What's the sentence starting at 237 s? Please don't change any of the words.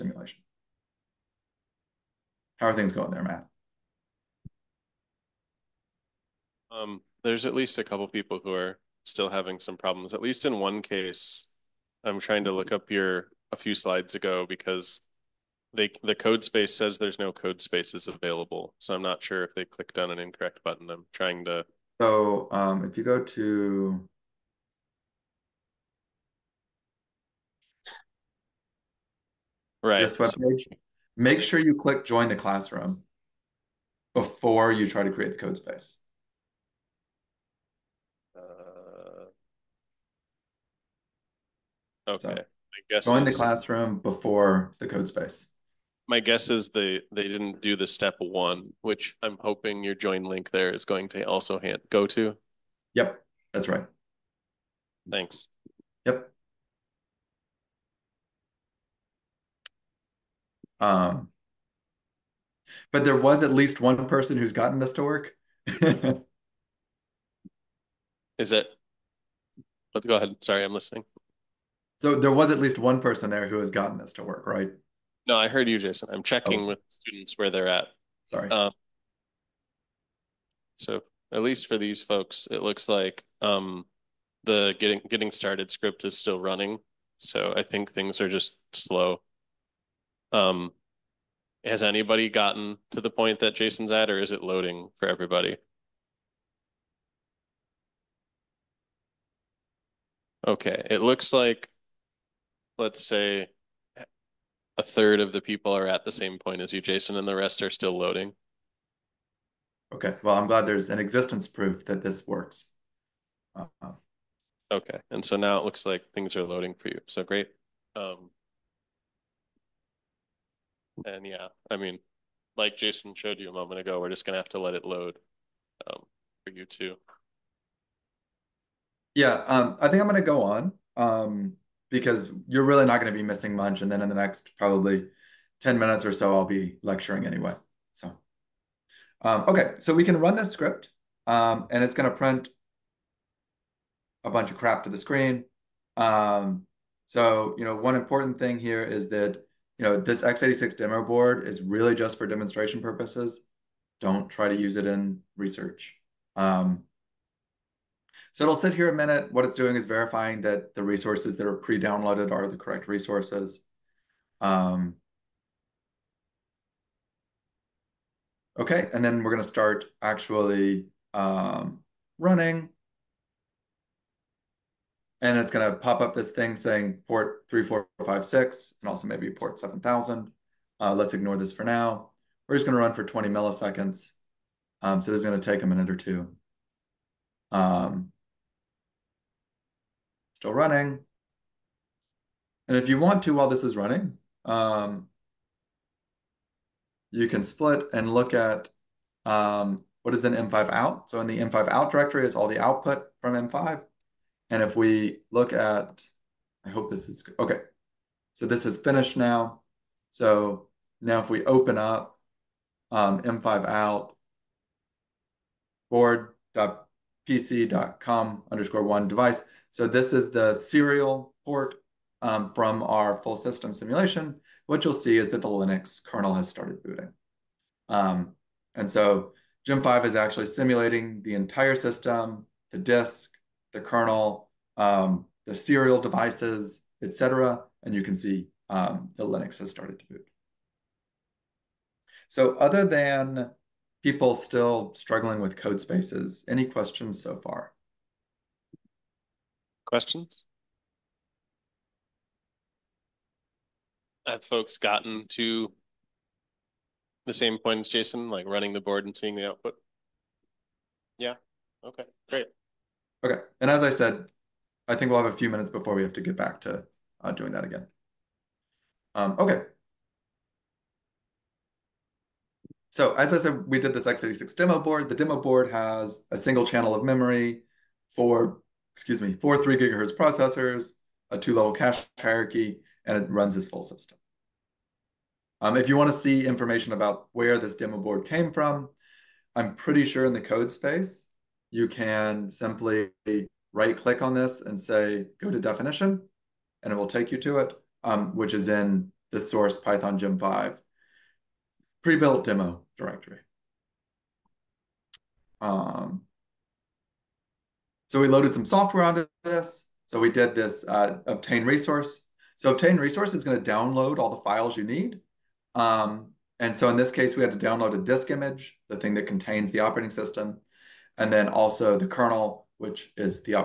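And you can see um, the Linux has started to boot.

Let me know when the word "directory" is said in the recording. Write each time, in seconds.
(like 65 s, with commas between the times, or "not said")
201 s, 302 s.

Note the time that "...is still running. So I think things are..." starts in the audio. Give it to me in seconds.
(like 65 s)
86 s.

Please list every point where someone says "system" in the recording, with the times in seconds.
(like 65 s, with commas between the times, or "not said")
223 s, 231 s, 283 s, 320 s.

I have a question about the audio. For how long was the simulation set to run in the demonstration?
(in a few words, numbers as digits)
20 milliseconds.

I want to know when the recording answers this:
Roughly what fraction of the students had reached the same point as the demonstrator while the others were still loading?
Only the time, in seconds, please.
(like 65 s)
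104 s.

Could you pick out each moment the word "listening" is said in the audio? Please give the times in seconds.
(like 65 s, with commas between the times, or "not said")
70 s.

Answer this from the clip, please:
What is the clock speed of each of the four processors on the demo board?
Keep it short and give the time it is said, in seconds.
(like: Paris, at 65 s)
3 gigahertz, at 279 s.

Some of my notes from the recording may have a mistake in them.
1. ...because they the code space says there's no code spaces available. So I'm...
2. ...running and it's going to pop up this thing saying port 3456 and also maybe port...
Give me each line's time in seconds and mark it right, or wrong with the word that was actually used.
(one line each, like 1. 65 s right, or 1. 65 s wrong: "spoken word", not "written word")
1. 14 s right
2. 172 s right.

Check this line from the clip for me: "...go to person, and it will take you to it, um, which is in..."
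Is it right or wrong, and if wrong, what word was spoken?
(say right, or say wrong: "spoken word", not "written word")
wrong: "definition", not "person".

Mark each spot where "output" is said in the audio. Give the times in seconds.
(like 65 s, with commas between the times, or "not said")
202 s, 259 s.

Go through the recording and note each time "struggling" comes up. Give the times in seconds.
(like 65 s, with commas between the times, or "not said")
244 s.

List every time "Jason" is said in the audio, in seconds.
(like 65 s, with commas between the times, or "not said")
75 s, 93 s, 106 s, 122 s, 257 s.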